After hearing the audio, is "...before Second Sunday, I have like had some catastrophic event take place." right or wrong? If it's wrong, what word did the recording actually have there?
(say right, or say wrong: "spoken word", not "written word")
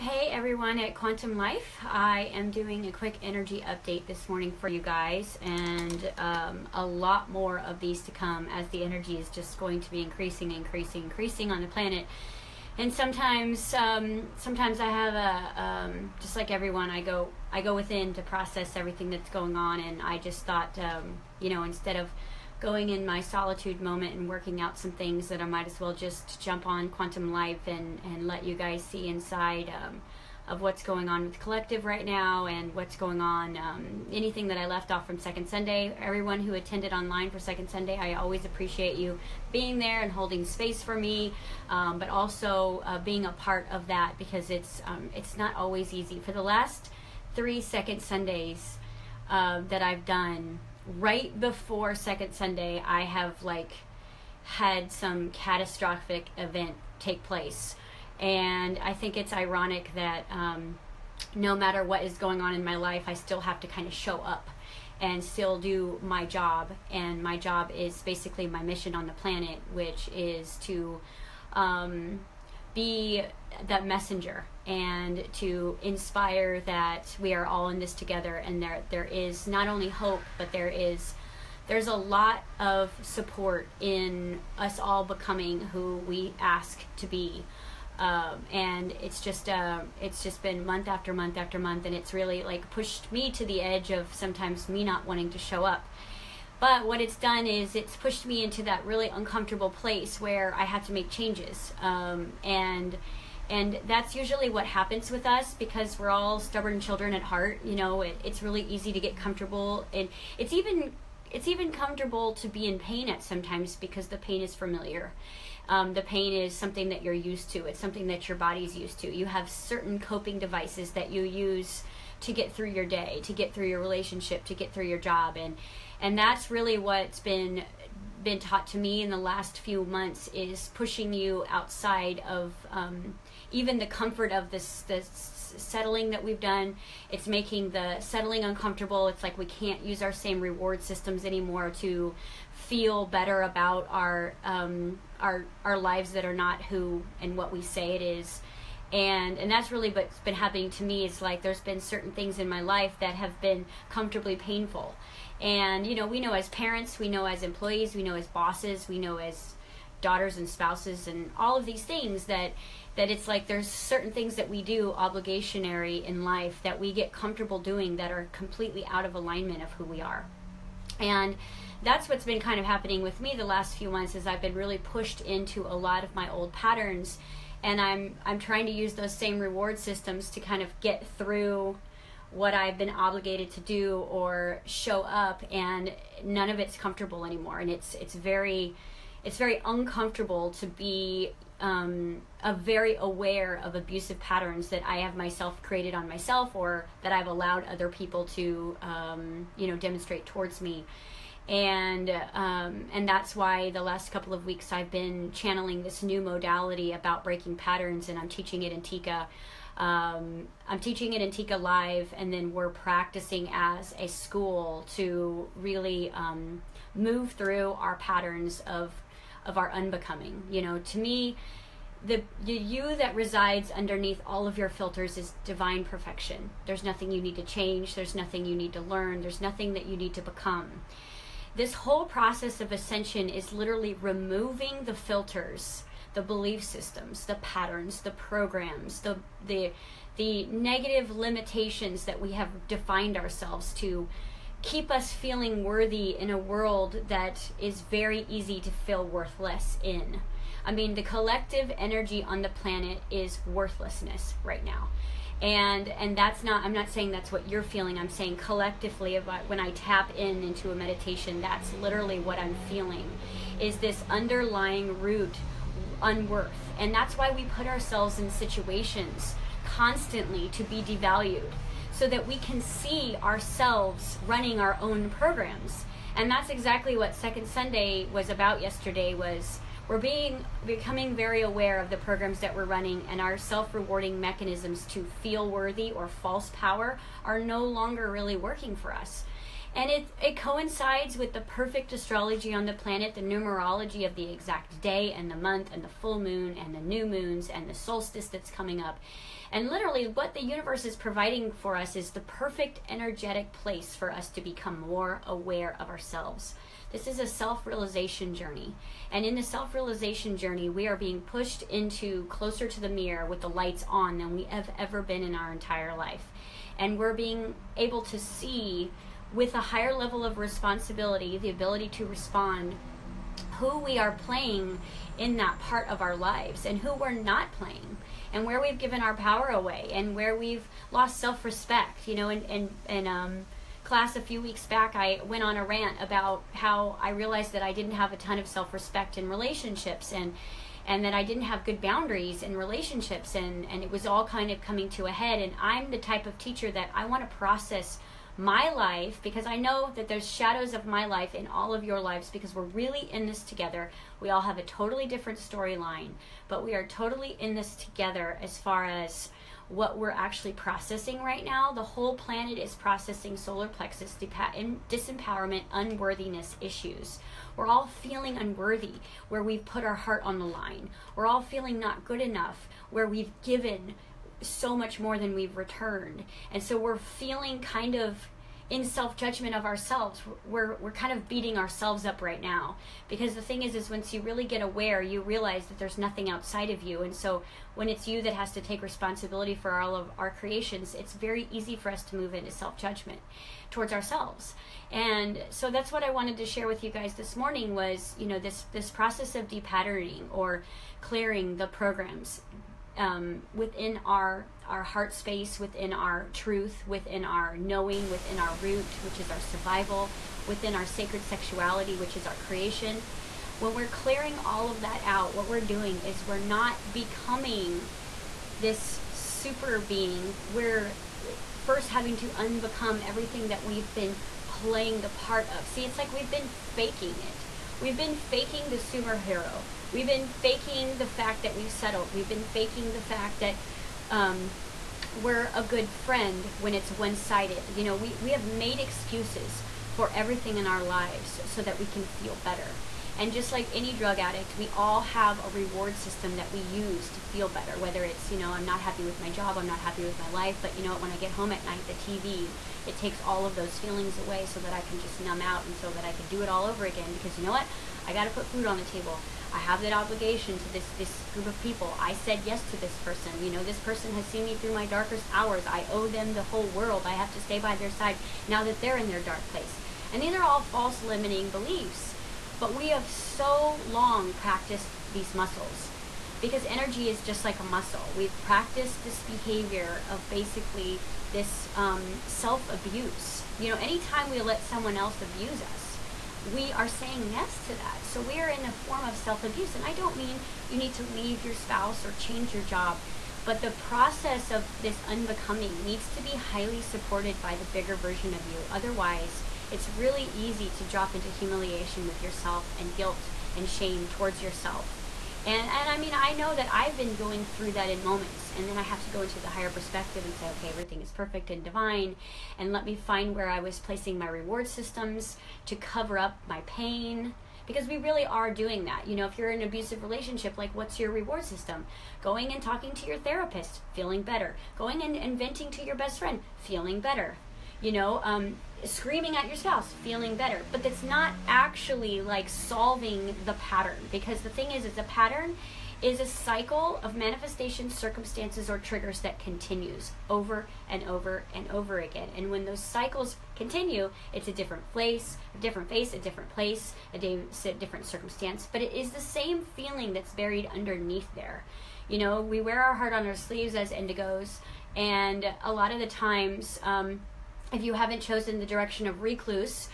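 right.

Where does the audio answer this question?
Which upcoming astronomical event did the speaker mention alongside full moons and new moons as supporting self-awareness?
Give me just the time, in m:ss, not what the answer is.
4:57.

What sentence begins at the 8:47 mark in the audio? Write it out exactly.
You know, um, screaming at your spouse, feeling better.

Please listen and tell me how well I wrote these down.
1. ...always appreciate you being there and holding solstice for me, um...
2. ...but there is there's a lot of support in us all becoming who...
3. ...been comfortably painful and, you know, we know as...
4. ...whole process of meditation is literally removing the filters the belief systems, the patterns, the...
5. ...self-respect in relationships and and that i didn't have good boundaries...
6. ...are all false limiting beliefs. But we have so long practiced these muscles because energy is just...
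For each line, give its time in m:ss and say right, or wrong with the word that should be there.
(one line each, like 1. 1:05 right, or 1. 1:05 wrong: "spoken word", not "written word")
1. 0:38 wrong: "space", not "solstice"
2. 1:20 right
3. 2:33 right
4. 3:51 wrong: "ascension", not "meditation"
5. 5:38 right
6. 7:50 right.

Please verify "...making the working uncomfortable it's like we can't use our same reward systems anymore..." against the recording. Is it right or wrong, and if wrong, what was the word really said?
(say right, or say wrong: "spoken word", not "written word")
wrong: "settling", not "working".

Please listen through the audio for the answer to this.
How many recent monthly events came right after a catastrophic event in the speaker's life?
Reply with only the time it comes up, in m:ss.
0:47.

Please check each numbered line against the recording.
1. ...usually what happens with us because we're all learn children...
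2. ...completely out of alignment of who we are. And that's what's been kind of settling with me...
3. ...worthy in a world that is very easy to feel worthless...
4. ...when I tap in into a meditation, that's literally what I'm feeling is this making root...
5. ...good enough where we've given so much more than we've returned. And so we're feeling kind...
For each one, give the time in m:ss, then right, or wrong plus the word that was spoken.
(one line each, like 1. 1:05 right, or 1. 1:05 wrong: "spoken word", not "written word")
1. 1:44 wrong: "stubborn", not "learn"
2. 2:48 wrong: "happening", not "settling"
3. 4:05 right
4. 4:19 wrong: "underlying", not "making"
5. 6:12 right.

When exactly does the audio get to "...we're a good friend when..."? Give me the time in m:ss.
7:15.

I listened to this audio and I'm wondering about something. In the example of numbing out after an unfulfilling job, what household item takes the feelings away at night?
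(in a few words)
the TV.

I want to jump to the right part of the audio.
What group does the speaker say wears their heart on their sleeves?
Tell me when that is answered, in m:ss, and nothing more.
9:13.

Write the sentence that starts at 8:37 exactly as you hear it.
Because we really are doing that.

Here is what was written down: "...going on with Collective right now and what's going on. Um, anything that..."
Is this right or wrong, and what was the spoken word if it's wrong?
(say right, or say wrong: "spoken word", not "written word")
right.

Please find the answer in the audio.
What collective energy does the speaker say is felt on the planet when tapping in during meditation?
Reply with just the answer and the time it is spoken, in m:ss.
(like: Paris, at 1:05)
worthlessness, at 4:13.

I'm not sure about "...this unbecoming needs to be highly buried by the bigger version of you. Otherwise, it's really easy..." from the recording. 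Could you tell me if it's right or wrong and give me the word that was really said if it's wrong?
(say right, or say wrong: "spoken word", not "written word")
wrong: "supported", not "buried".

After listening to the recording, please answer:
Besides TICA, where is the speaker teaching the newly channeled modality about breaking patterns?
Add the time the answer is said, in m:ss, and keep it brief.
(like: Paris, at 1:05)
Antica Live, at 3:31.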